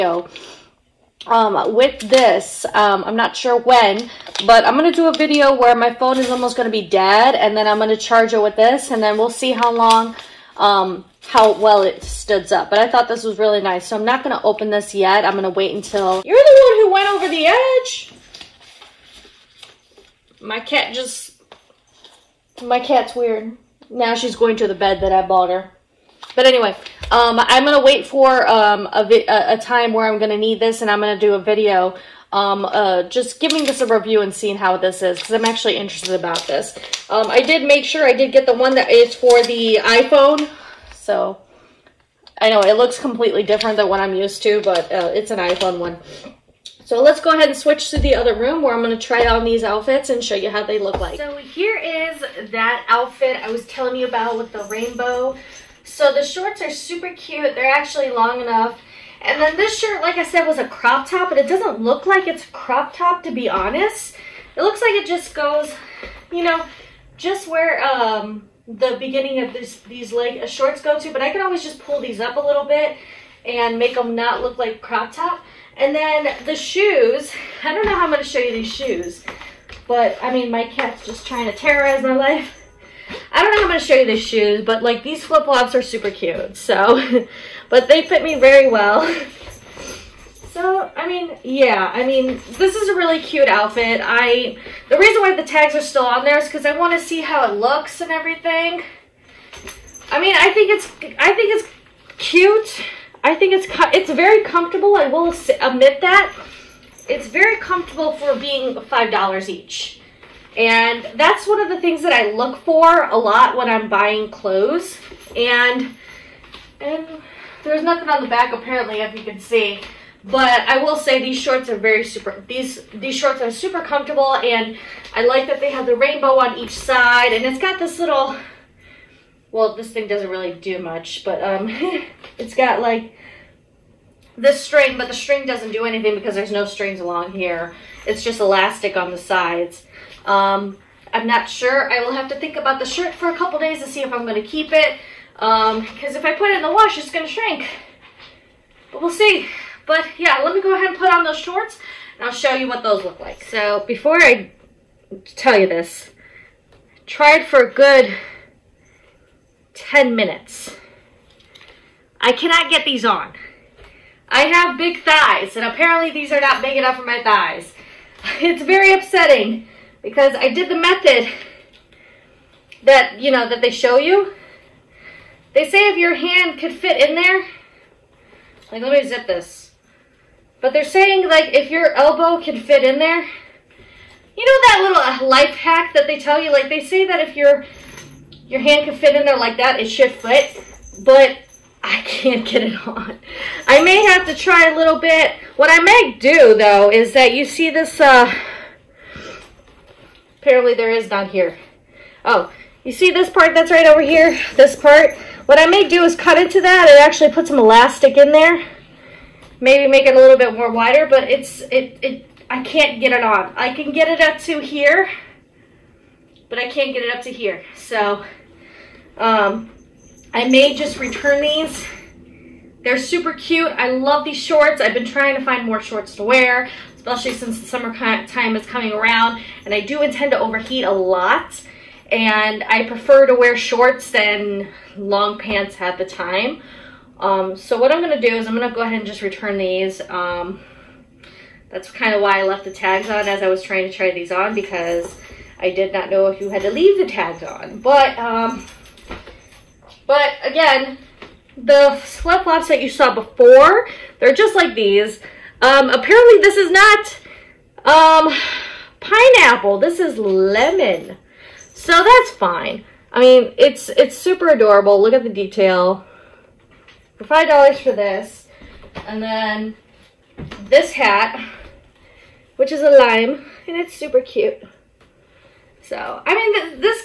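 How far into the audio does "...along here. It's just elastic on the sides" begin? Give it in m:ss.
2:16.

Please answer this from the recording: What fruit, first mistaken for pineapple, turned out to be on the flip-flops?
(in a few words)
lemon.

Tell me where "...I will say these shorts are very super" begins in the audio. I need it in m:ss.
2:00.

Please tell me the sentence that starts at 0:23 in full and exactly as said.
Now she's going to the bed that I bought her.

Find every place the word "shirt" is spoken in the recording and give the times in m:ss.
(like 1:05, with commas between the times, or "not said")
0:59, 2:22.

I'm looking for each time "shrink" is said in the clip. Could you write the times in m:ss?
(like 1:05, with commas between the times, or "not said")
2:27.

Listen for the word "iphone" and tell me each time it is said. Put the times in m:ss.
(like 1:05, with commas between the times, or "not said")
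0:39, 0:45.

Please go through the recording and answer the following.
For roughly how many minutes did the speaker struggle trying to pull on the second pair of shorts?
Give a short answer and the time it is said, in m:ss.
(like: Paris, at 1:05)
10 minutes, at 2:39.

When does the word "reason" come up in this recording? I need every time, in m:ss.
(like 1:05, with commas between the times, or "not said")
1:34.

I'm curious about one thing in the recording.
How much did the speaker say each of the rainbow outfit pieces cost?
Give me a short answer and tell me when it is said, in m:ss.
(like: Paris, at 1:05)
$5, at 1:48.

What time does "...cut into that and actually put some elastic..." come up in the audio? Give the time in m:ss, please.
3:26.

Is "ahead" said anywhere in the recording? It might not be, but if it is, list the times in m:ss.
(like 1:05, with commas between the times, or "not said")
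0:47, 2:30, 3:58.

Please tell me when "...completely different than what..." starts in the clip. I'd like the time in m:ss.
0:42.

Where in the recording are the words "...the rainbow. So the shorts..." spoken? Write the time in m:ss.
0:54.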